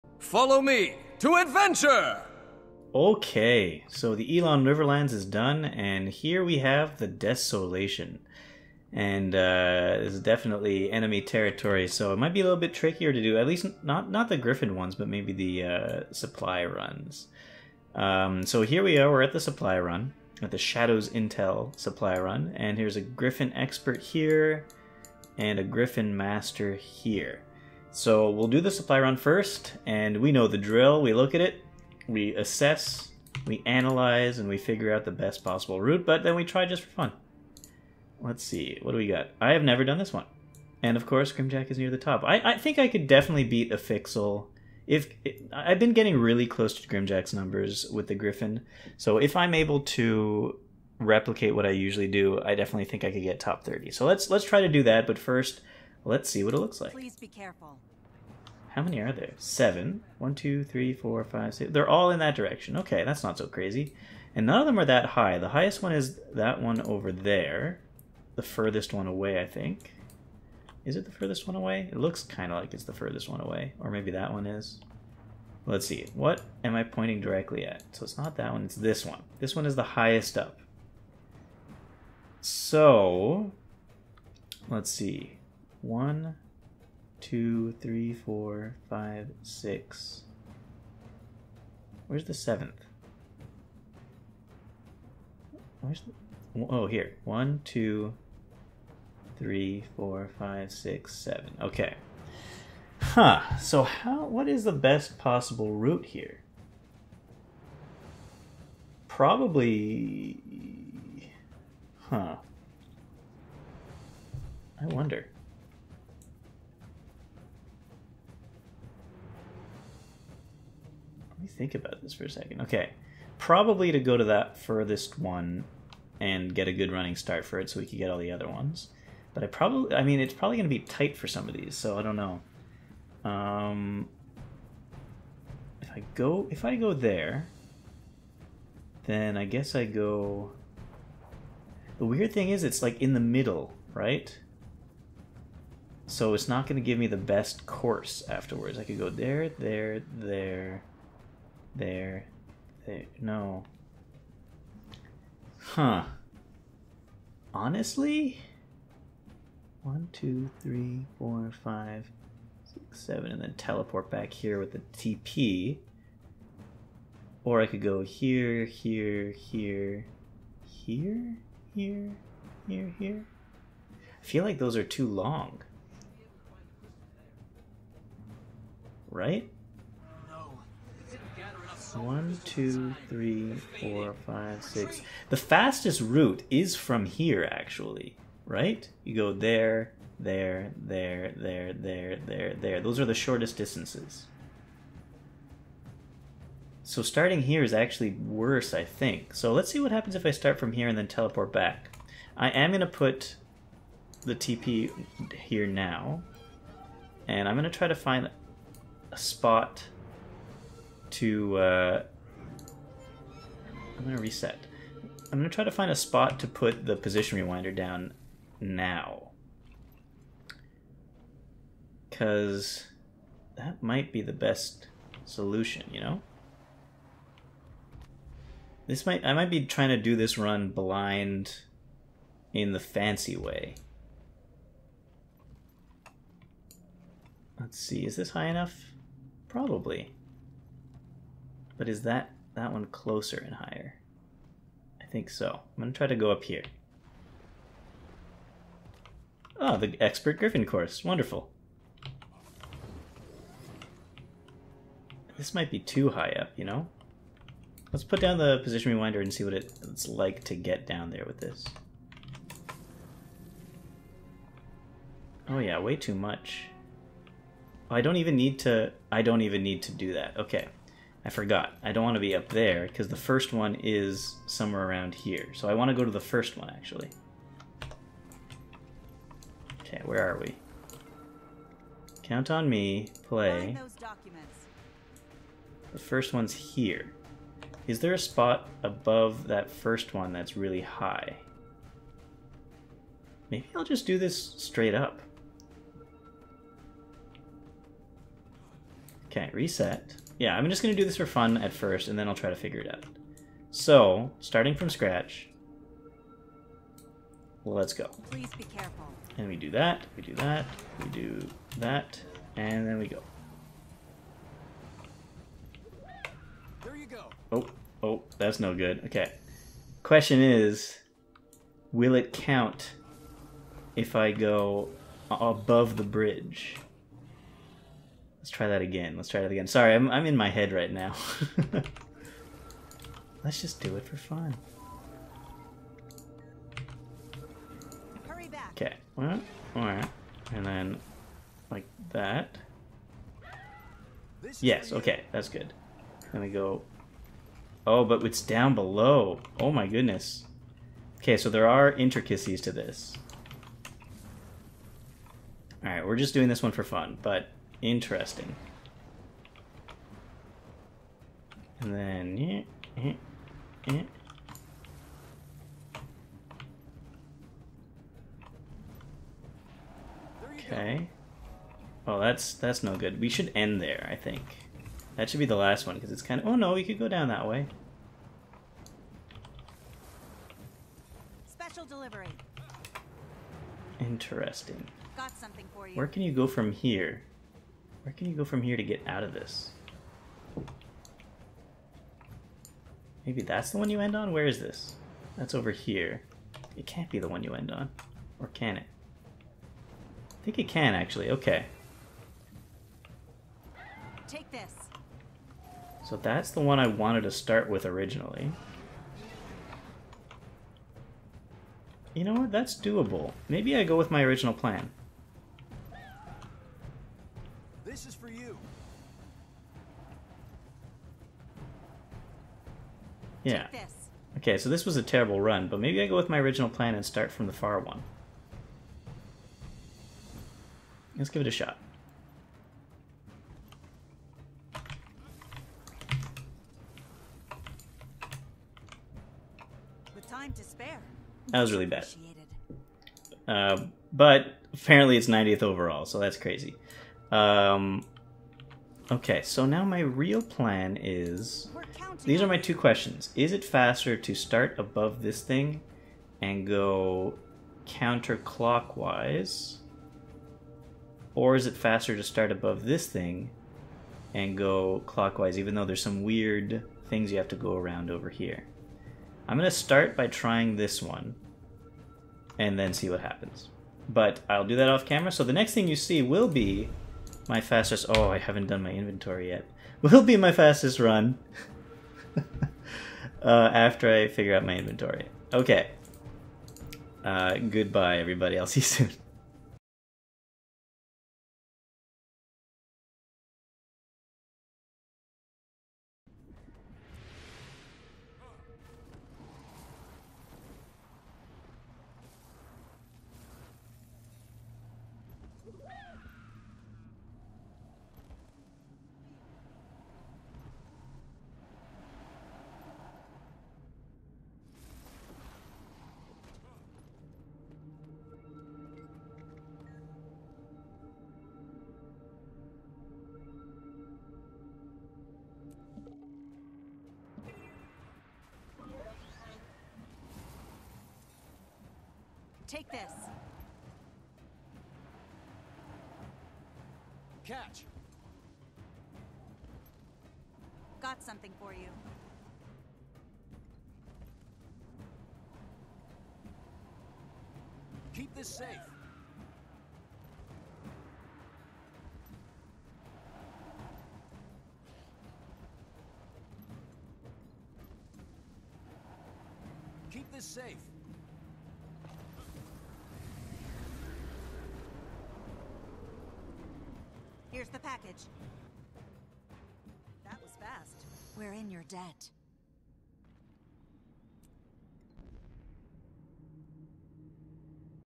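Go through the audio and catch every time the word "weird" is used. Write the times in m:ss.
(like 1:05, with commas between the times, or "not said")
2:22, 7:46.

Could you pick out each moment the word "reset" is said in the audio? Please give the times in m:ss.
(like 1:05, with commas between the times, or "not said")
3:34, 4:59.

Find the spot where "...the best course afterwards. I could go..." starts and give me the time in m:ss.
2:27.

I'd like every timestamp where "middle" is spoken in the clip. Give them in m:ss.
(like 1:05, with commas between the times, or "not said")
2:23.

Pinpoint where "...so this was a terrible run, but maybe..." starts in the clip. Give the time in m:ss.
7:04.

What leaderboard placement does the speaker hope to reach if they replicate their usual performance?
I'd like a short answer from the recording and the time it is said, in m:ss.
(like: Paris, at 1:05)
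top 30, at 0:53.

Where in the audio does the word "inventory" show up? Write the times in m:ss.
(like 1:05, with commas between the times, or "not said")
7:58, 8:04.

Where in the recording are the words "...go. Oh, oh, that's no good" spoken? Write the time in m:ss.
5:17.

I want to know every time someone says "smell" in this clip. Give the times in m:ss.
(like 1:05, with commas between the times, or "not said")
not said.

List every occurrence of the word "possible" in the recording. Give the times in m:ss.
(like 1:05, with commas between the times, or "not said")
0:35, 1:45.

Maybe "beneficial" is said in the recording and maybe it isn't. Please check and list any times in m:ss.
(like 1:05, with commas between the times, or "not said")
not said.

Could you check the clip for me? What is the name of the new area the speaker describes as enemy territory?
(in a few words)
the Desolation.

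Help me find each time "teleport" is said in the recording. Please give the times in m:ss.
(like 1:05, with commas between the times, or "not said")
2:43, 3:21.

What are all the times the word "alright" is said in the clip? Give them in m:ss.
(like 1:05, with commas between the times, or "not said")
5:39, 5:55.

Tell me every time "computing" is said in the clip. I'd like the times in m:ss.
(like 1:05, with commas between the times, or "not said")
not said.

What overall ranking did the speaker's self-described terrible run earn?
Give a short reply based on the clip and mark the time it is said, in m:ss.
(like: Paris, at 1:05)
90th, at 7:25.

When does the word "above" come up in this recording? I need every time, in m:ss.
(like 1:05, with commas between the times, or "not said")
4:48, 5:25, 7:34, 7:42.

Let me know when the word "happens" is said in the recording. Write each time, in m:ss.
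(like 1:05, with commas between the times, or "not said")
3:19, 7:53.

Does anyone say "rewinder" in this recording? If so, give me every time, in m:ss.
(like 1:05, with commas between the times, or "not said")
3:37, 4:18.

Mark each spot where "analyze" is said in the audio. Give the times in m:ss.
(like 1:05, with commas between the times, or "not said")
0:33.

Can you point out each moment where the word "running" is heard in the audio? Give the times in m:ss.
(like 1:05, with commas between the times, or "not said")
2:06.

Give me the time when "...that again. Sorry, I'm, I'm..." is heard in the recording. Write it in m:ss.
5:29.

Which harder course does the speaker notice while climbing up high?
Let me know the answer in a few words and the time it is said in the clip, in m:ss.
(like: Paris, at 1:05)
expert griffon course, at 4:09.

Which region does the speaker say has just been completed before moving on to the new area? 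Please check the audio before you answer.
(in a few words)
Elon Riverlands.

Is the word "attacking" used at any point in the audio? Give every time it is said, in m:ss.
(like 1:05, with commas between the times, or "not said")
not said.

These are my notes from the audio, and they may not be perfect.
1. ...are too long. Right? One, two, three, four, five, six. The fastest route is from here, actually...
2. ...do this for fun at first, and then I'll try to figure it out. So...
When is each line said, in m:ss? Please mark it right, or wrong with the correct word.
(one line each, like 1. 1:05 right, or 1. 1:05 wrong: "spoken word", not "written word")
1. 2:54 right
2. 5:00 right.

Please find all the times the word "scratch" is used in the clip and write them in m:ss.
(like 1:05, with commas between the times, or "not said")
5:04.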